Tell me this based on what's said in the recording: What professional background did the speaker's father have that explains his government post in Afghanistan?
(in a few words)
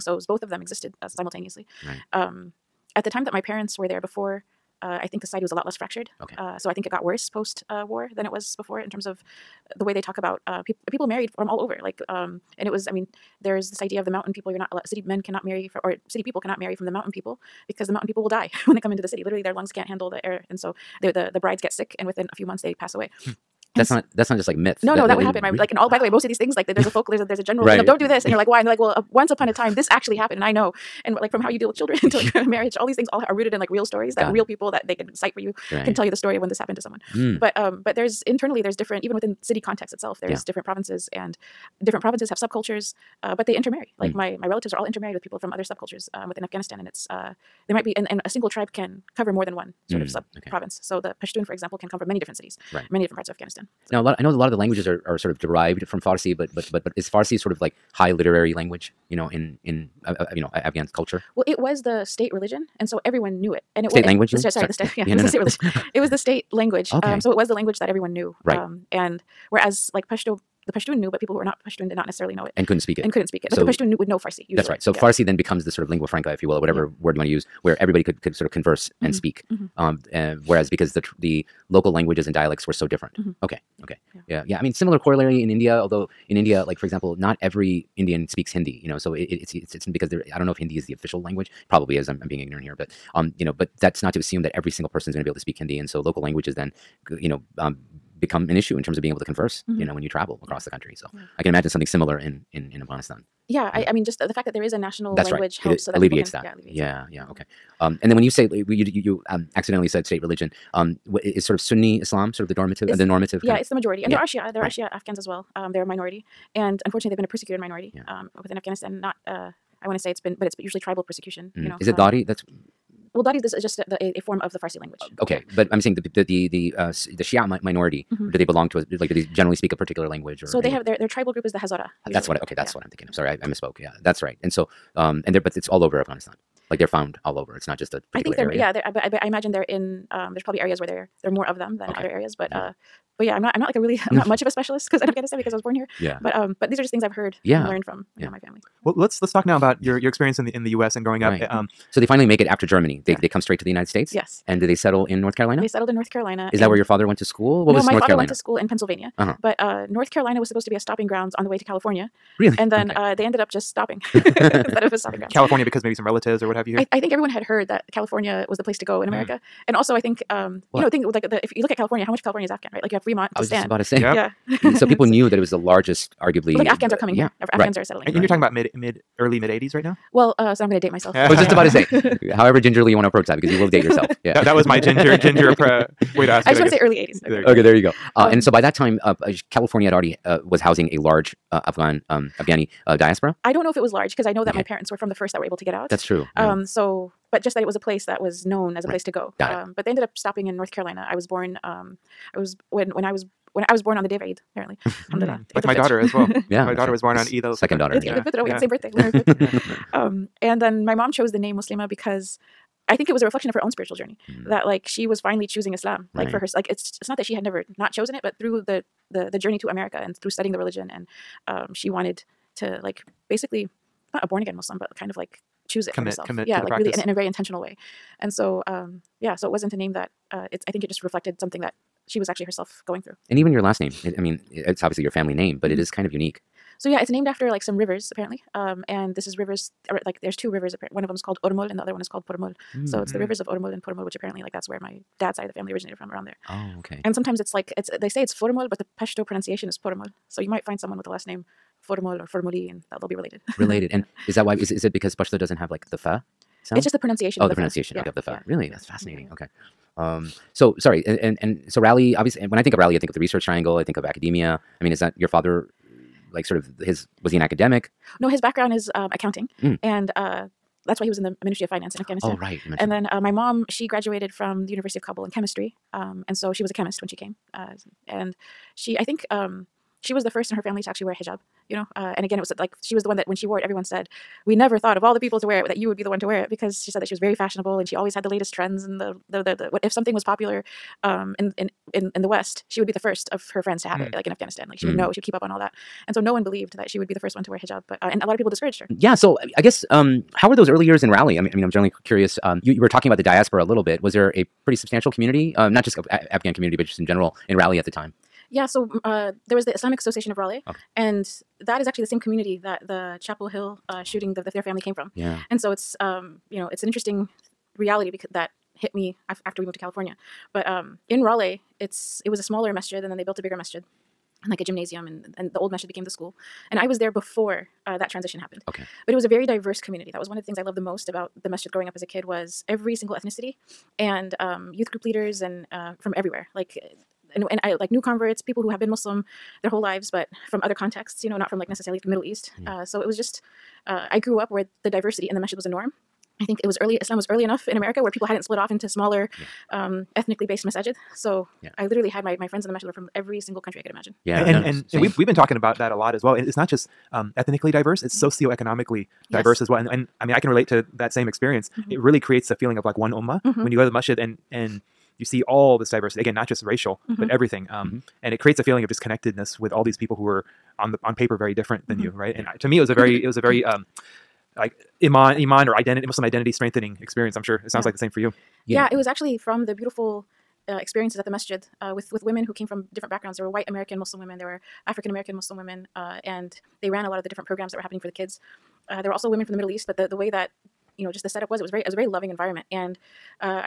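accounting.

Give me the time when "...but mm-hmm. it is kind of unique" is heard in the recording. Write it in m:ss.
3:55.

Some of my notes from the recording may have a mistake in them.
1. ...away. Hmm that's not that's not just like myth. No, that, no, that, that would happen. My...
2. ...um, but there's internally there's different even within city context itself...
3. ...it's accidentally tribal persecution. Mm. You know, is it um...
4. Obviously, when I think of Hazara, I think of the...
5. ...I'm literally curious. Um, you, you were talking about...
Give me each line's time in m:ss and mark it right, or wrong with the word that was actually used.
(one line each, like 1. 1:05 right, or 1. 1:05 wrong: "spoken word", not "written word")
1. 0:22 right
2. 0:37 right
3. 2:00 wrong: "usually", not "accidentally"
4. 4:22 wrong: "Raleigh", not "Hazara"
5. 5:01 wrong: "generally", not "literally".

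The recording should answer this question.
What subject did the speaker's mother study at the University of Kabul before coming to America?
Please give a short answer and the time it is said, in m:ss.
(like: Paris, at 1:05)
chemistry, at 4:35.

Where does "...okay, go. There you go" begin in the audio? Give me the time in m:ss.
3:07.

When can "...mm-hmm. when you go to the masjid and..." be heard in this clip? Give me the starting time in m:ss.
6:03.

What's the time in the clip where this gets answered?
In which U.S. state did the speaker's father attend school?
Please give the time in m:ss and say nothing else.
2:38.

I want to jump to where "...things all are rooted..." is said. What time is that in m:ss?
0:32.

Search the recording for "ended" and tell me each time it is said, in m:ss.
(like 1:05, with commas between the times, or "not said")
2:43, 3:19.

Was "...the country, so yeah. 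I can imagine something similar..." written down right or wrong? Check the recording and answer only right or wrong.
right.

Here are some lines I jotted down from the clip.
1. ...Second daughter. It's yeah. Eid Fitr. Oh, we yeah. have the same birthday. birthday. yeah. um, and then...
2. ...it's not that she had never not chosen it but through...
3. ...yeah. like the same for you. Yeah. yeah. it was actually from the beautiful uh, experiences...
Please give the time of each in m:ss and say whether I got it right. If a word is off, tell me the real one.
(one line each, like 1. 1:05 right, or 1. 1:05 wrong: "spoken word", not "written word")
1. 3:27 right
2. 3:37 right
3. 6:17 right.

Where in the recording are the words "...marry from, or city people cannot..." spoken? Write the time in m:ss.
0:15.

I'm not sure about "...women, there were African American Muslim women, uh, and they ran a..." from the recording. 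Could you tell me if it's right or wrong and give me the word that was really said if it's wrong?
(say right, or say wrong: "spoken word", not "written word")
right.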